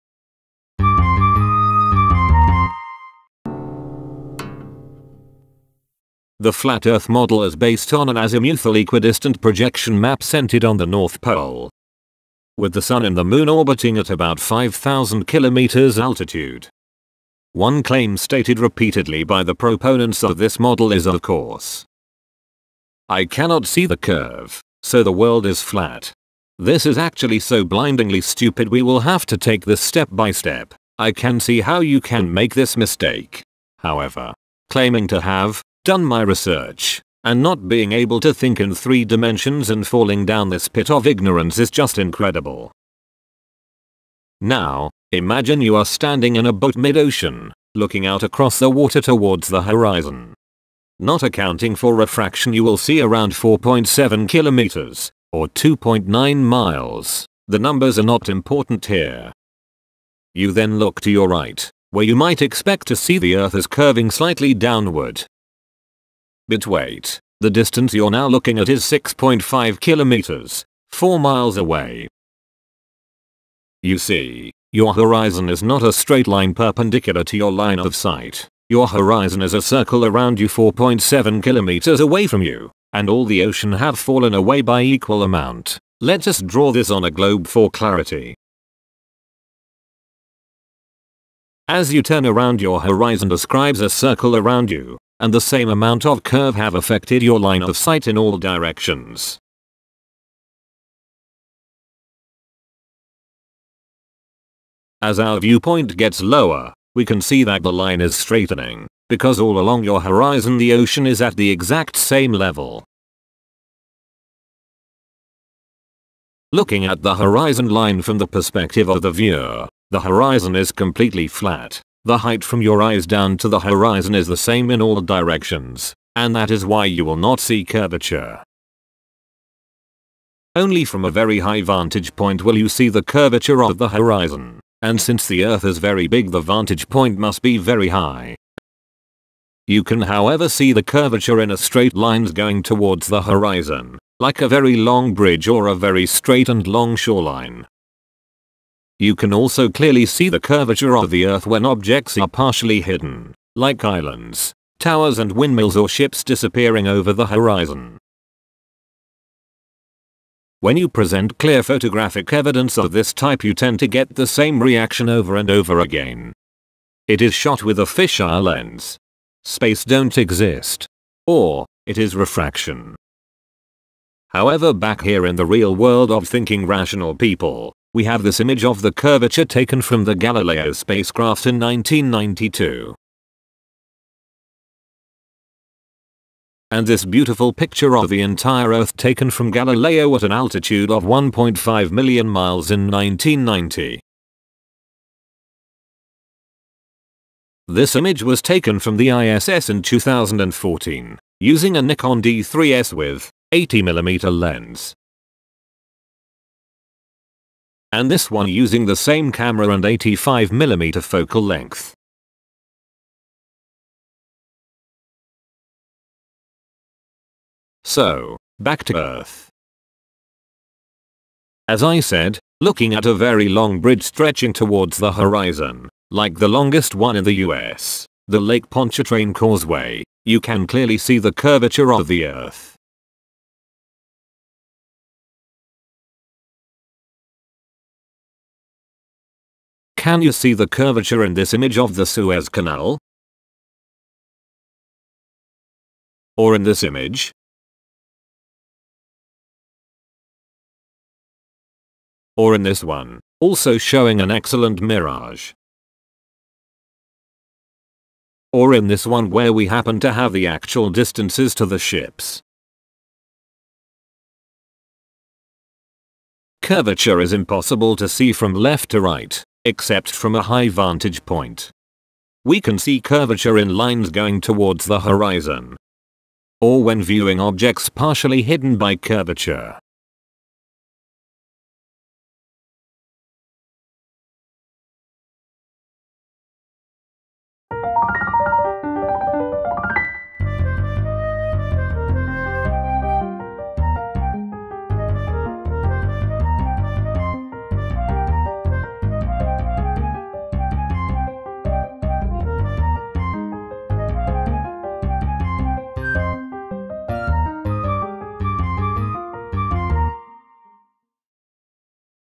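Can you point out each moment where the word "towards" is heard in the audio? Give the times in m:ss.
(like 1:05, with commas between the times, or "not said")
0:49, 2:22, 3:44, 4:34.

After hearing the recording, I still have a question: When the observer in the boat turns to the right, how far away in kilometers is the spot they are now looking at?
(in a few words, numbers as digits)
6.5 kilometers.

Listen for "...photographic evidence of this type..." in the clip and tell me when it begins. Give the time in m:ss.
2:41.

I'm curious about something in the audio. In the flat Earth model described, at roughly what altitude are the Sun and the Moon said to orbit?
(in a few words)
5,000 kilometers.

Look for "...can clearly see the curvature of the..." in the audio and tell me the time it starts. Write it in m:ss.
3:50.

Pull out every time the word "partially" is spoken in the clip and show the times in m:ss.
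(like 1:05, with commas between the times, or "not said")
2:32, 4:37.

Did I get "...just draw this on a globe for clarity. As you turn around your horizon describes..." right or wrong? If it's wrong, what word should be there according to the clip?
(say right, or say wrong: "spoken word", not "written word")
right.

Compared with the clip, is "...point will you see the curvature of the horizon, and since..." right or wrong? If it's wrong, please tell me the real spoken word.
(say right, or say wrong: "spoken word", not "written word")
right.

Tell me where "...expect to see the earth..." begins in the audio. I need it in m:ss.
1:02.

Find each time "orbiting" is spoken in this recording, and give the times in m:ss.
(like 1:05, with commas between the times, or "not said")
0:13.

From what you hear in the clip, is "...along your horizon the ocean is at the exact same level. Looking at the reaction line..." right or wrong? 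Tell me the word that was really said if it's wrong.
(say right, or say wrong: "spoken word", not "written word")
wrong: "horizon", not "reaction".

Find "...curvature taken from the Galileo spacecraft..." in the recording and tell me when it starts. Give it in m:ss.
2:58.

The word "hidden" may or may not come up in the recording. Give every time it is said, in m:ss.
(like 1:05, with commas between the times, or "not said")
2:32, 4:38.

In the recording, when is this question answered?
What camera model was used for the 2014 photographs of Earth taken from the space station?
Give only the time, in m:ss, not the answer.
3:21.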